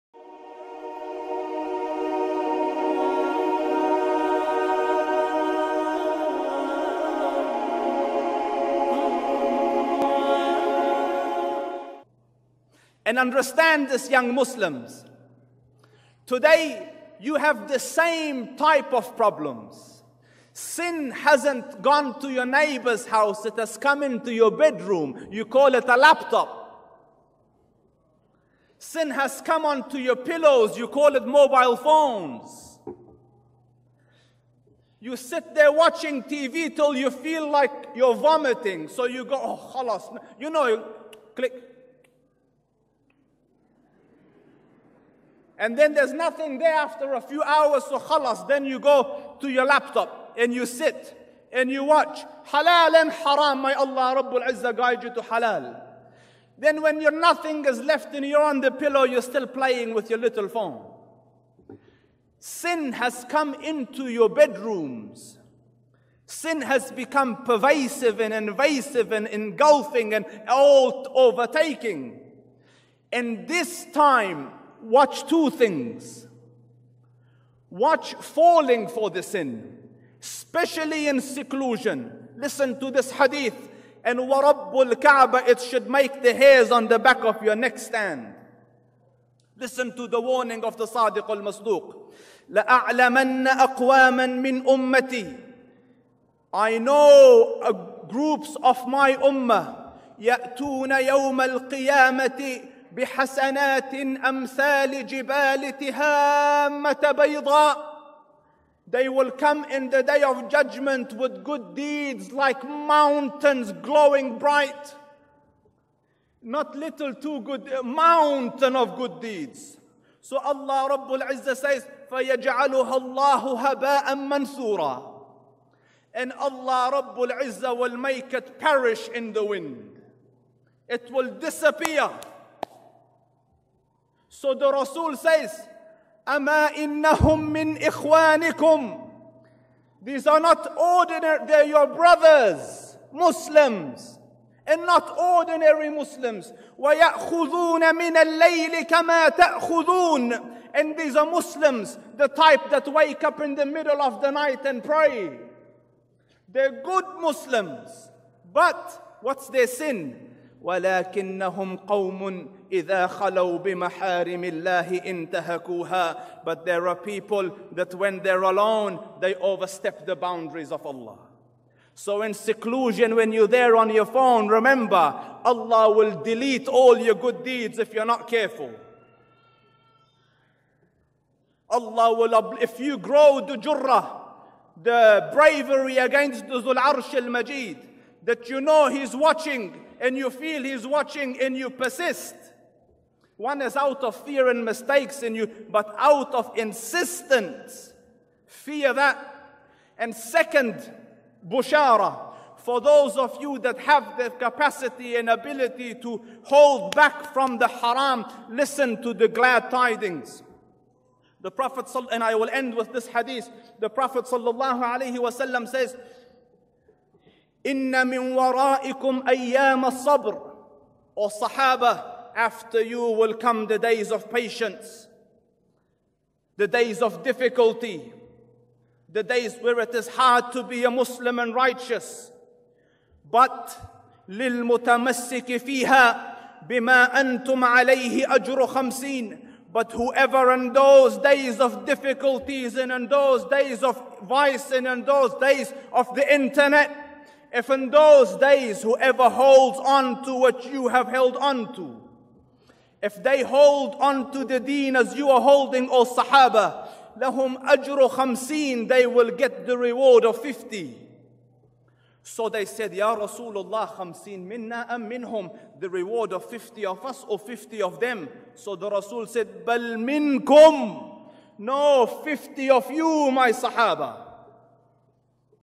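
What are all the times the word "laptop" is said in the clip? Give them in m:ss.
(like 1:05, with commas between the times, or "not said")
0:25, 0:49.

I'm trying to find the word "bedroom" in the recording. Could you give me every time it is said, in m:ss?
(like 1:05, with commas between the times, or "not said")
0:24, 1:04.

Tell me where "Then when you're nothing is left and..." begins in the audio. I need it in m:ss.
0:56.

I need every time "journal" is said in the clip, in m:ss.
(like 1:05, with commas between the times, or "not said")
not said.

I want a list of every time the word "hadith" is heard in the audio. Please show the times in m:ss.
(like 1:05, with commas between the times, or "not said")
1:23, 3:33.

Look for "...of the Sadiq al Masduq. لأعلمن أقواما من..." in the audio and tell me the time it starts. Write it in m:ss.
1:30.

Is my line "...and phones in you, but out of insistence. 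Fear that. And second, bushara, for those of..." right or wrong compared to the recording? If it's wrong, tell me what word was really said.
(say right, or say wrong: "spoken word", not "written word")
wrong: "mistakes", not "phones".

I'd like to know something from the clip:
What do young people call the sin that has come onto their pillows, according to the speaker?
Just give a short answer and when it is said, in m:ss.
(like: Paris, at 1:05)
mobile phones, at 0:31.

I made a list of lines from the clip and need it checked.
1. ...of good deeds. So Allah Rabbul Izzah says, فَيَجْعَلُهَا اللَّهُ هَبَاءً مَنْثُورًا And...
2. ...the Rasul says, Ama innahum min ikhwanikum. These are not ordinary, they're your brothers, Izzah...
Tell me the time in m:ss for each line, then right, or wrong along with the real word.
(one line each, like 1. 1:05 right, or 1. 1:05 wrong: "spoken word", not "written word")
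1. 1:58 right
2. 2:14 wrong: "Muslims", not "Izzah".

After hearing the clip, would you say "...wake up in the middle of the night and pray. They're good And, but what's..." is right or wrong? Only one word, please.
wrong.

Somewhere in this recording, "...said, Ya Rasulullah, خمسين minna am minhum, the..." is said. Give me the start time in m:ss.
4:22.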